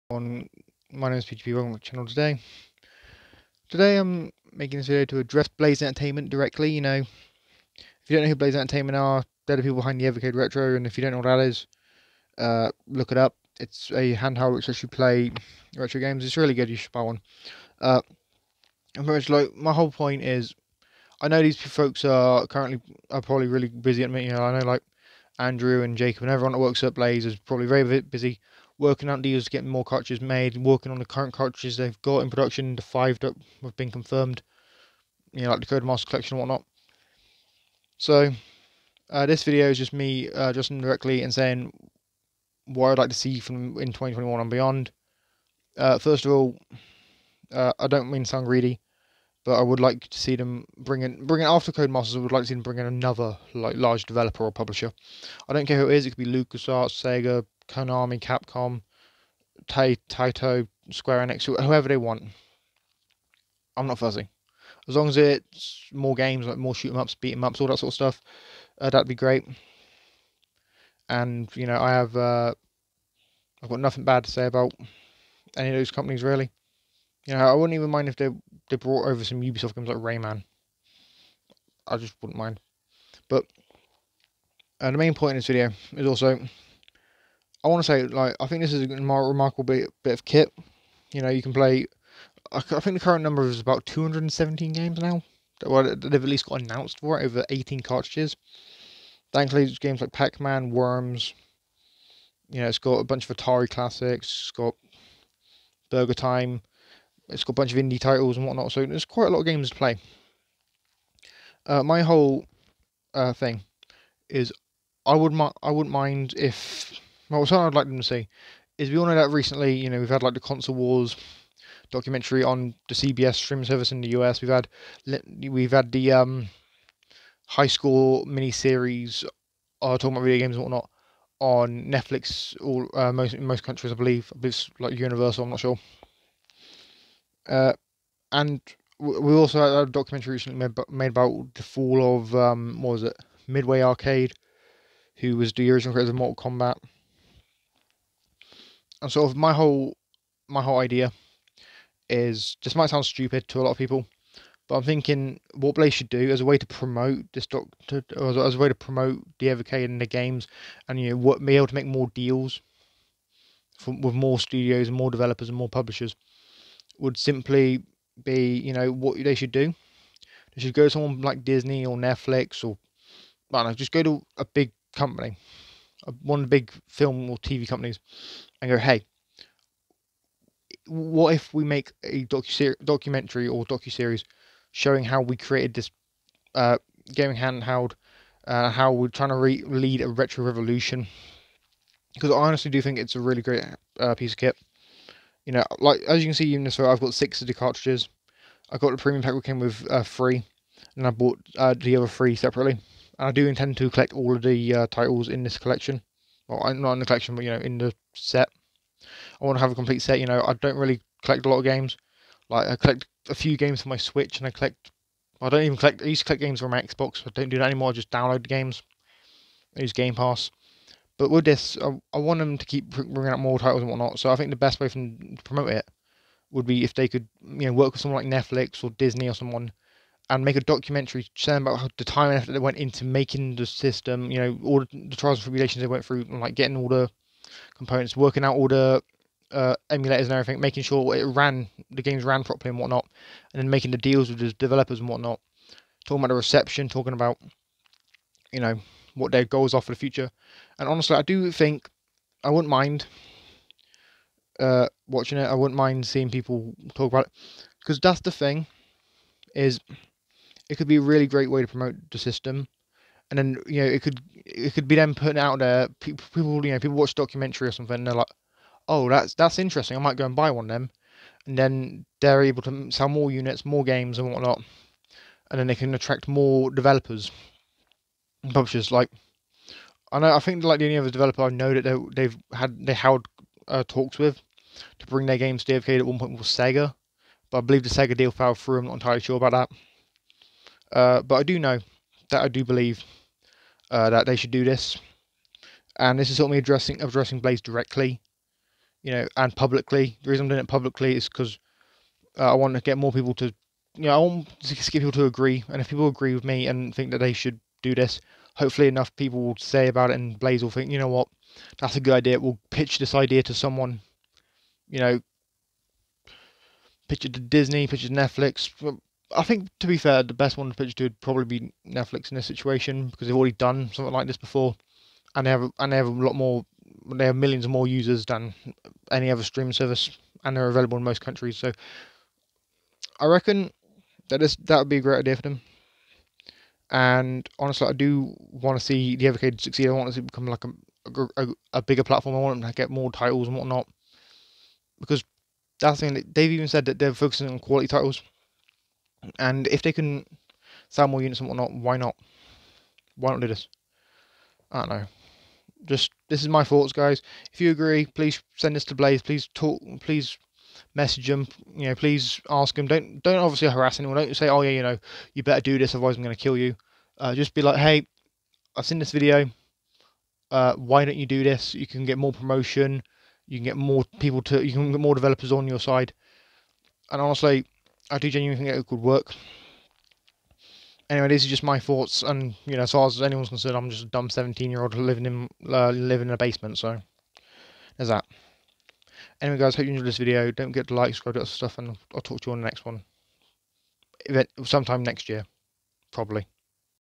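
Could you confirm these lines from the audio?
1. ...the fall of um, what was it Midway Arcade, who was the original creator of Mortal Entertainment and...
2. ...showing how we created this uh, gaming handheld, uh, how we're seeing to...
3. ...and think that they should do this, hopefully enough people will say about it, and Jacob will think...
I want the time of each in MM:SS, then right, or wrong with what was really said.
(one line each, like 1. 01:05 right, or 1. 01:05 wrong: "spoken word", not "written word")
1. 02:21 wrong: "Kombat", not "Entertainment"
2. 03:04 wrong: "trying", not "seeing"
3. 05:06 wrong: "Blaze", not "Jacob".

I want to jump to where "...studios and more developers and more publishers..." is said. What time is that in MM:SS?
02:44.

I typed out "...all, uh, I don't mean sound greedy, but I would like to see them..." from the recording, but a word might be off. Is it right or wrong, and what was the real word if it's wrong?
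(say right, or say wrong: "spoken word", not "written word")
right.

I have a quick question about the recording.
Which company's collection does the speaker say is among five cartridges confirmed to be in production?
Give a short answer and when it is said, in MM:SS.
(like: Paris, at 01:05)
Codemasters, at 00:35.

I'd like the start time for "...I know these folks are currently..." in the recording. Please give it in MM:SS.
00:21.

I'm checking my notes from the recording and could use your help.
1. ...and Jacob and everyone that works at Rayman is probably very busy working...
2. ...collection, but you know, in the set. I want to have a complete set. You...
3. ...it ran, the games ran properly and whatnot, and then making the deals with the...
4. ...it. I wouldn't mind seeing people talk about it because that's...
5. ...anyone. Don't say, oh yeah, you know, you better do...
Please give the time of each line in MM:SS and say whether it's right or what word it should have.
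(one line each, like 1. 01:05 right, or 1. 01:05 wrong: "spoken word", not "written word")
1. 00:25 wrong: "Blaze", not "Rayman"
2. 03:27 right
3. 04:01 right
4. 04:15 right
5. 06:03 right.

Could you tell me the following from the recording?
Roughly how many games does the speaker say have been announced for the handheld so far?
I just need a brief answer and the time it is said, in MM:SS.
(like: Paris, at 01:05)
217, at 01:33.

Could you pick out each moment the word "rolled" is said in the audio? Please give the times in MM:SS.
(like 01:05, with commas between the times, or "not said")
not said.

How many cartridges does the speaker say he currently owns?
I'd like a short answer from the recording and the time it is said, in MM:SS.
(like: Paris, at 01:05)
6, at 03:17.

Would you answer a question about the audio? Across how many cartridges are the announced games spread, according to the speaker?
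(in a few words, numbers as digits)
18.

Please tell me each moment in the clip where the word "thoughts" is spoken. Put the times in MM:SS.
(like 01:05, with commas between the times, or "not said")
05:56, 06:21.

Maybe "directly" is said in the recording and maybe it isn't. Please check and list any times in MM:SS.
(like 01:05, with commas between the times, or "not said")
00:06, 00:40, 04:57.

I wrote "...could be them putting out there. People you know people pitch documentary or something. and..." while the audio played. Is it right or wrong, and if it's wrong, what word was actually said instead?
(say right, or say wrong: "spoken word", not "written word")
wrong: "watch", not "pitch".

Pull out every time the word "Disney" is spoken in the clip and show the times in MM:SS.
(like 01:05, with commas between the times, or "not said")
02:51, 03:48, 05:17.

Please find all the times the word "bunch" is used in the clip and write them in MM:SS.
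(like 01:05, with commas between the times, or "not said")
01:43, 01:47.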